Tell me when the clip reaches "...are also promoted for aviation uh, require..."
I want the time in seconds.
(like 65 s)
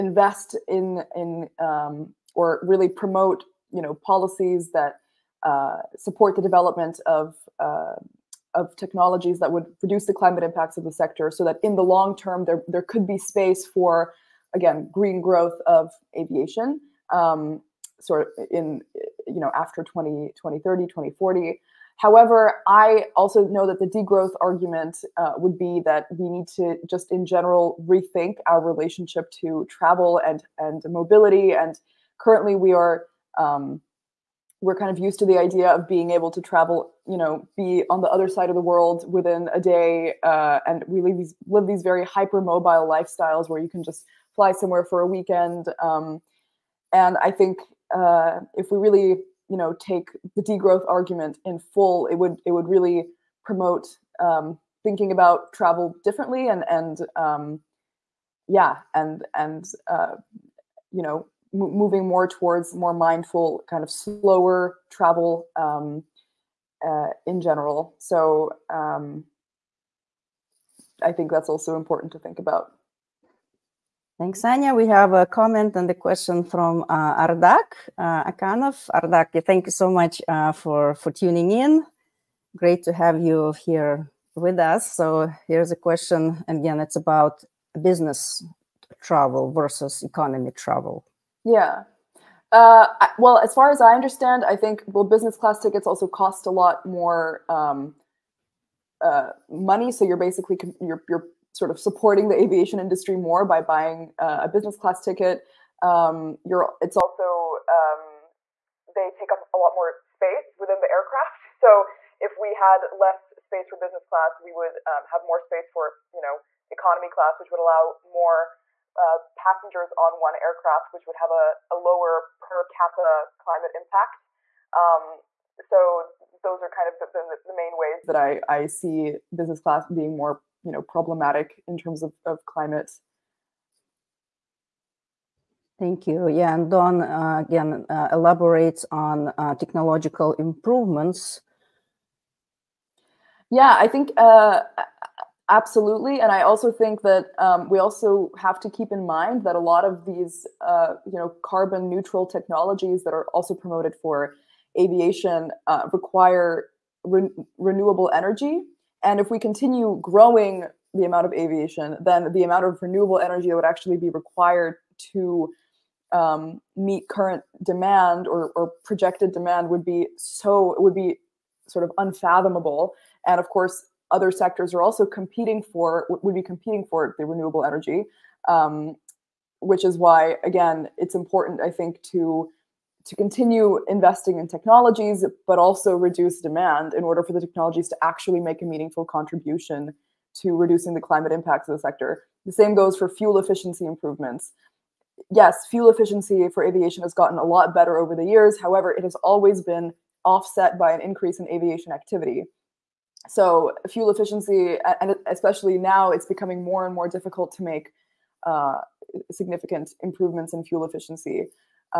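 153 s.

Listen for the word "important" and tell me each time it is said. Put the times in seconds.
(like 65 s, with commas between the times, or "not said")
71 s, 181 s.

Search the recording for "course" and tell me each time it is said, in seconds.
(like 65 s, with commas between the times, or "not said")
173 s.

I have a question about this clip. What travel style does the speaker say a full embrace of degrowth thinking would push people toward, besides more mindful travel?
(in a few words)
slower travel.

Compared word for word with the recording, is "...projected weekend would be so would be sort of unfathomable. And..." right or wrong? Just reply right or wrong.
wrong.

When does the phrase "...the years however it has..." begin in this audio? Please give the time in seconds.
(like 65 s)
198 s.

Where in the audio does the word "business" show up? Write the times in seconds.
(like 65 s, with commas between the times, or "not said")
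87 s, 95 s, 104 s, 113 s, 129 s.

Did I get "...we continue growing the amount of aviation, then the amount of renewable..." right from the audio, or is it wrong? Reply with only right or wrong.
right.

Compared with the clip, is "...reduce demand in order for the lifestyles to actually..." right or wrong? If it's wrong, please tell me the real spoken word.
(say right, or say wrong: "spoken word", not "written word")
wrong: "technologies", not "lifestyles".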